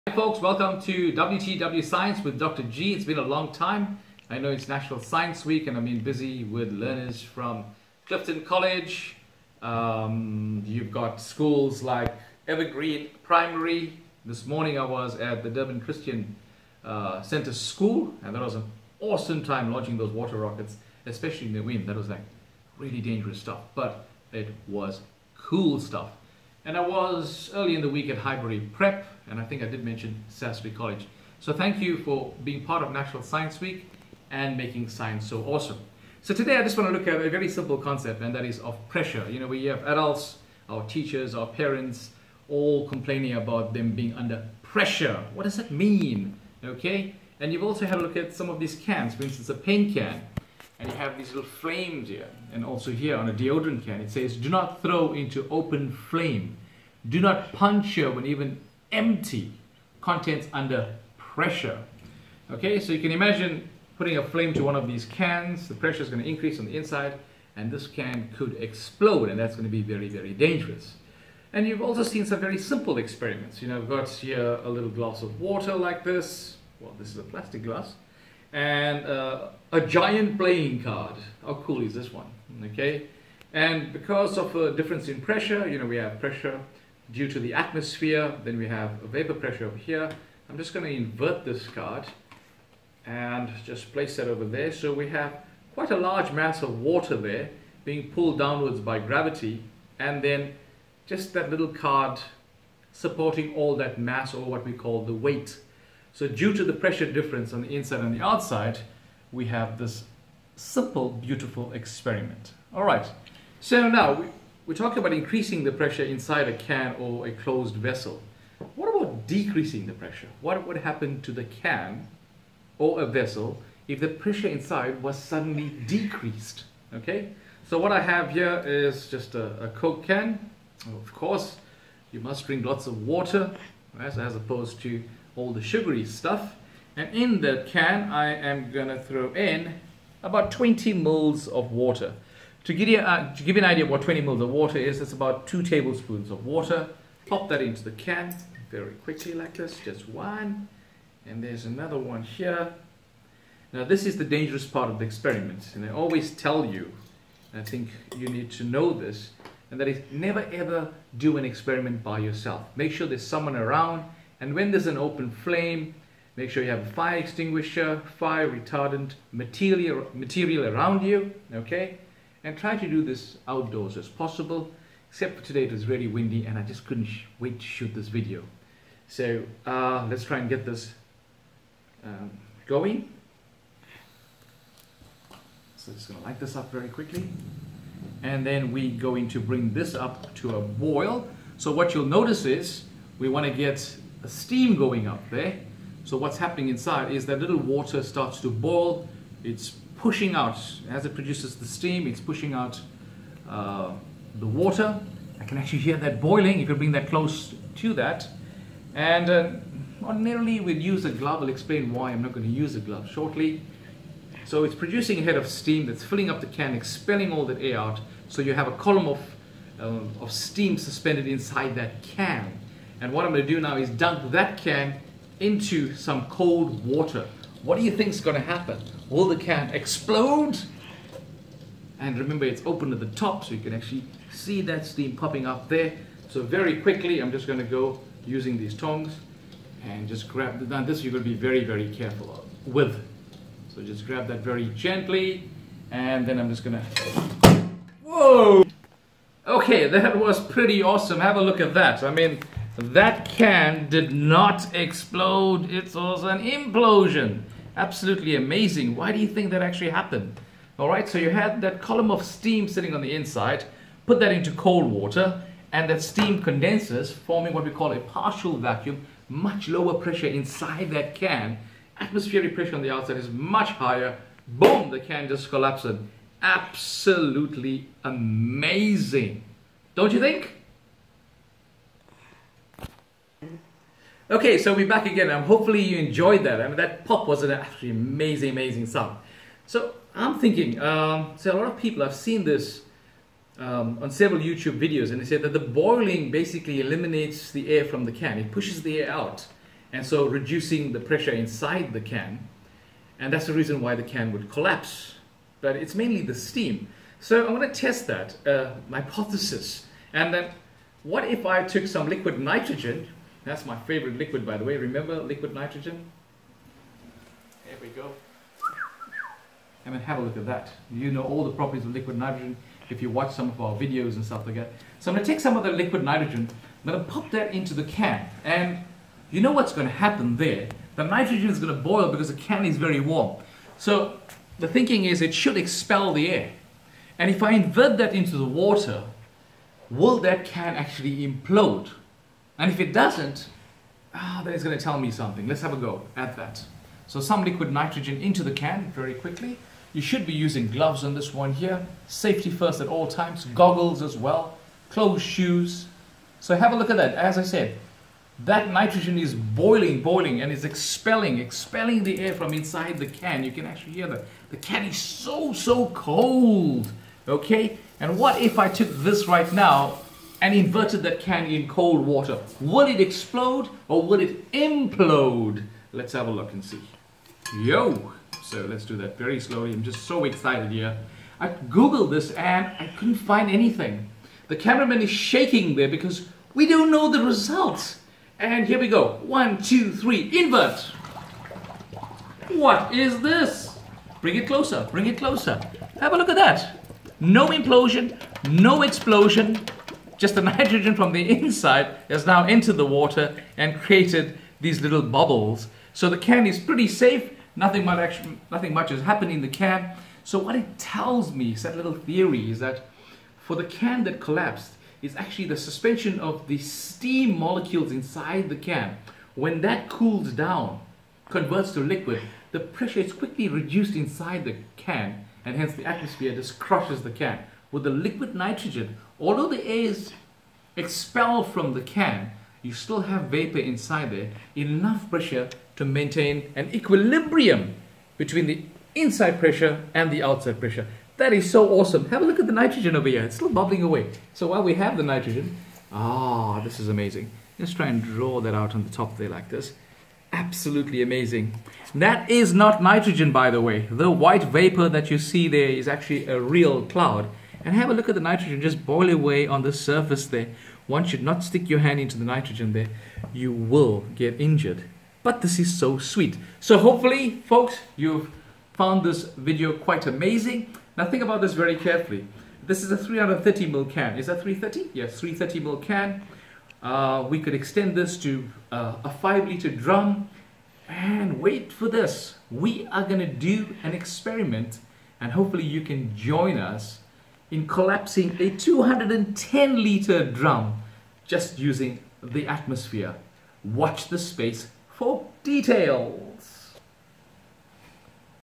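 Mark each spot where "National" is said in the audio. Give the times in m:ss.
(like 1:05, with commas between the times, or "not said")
0:04, 0:32.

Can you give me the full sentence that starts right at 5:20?
You know all the properties of liquid nitrogen if you watch some of our videos and stuff like that.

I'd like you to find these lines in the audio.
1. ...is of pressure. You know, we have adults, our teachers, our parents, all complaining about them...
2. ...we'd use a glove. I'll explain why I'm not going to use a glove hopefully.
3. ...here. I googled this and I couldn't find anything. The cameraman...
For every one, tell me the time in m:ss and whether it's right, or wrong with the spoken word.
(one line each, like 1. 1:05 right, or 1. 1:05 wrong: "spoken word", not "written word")
1. 0:38 right
2. 3:30 wrong: "shortly", not "hopefully"
3. 6:20 right.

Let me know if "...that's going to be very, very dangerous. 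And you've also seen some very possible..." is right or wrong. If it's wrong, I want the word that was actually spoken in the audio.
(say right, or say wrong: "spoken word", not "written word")
wrong: "simple", not "possible".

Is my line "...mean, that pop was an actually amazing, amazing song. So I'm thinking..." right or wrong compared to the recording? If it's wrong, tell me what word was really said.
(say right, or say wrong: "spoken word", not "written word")
right.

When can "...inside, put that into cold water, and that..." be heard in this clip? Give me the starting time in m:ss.
4:23.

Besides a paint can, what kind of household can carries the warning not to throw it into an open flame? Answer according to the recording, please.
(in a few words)
Deodorant can.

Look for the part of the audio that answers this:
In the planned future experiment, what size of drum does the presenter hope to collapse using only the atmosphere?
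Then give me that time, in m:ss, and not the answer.
8:08.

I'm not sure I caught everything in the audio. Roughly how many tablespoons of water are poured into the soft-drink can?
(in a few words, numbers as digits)
2.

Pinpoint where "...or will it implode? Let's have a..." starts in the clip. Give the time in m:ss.
6:13.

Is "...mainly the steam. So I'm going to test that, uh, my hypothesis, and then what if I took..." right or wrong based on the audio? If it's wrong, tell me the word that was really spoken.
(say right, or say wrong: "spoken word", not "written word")
right.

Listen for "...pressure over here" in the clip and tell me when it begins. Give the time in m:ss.
1:29.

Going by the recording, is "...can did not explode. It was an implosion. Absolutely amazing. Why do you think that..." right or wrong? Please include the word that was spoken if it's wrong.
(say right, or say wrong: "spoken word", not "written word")
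right.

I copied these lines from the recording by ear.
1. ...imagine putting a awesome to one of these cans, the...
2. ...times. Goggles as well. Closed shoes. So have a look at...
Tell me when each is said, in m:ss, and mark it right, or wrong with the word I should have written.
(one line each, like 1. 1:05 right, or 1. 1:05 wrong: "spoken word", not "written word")
1. 1:03 wrong: "flame", not "awesome"
2. 5:53 right.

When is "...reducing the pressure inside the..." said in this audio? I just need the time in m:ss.
5:00.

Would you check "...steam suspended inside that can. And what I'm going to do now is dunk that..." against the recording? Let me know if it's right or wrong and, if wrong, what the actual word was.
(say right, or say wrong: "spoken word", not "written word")
right.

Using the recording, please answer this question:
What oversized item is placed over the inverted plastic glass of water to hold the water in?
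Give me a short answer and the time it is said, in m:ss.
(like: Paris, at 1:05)
Giant playing card, at 1:19.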